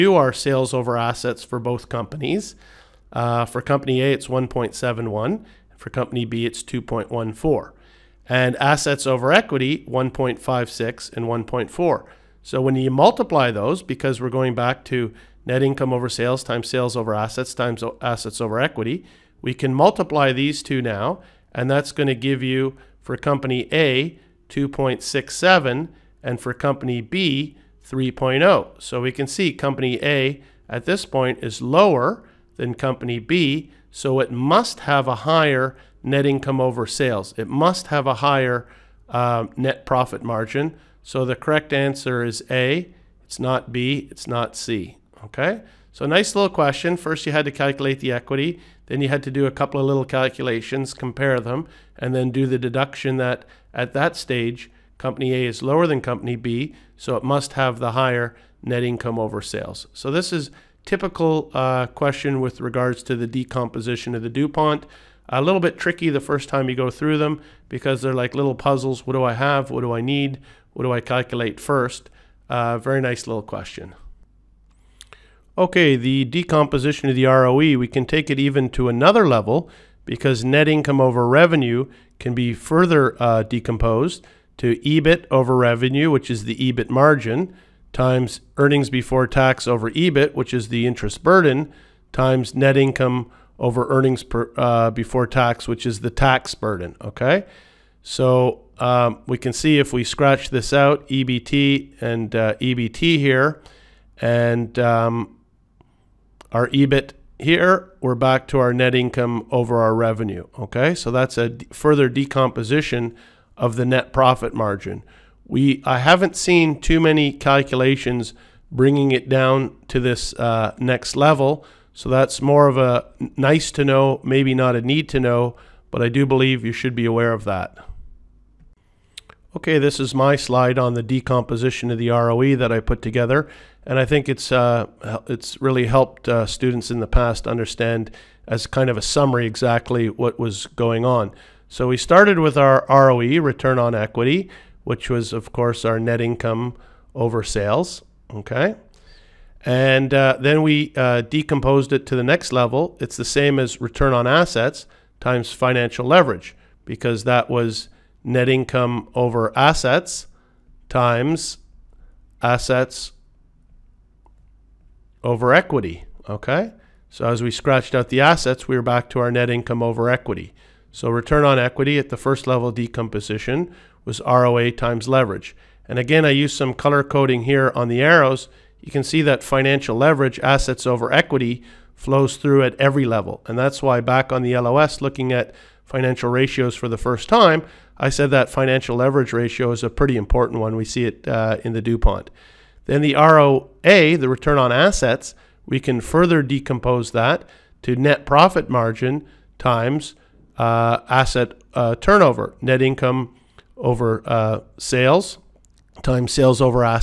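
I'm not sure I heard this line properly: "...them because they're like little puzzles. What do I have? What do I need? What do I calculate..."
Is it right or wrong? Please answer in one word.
right.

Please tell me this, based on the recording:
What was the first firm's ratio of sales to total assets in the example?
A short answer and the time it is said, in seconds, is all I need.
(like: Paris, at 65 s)
1.71, at 4 s.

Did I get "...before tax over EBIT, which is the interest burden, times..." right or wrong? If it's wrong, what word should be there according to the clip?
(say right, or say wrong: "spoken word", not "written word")
right.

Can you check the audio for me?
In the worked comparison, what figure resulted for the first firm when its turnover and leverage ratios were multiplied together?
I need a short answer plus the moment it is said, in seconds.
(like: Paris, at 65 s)
2.67, at 24 s.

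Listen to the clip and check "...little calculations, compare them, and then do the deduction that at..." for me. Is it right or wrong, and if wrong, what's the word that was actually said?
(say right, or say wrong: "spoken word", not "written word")
right.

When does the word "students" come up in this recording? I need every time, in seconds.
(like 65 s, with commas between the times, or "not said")
136 s.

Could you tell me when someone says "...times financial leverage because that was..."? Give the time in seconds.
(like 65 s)
155 s.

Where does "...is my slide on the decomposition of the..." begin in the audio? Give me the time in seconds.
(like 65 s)
129 s.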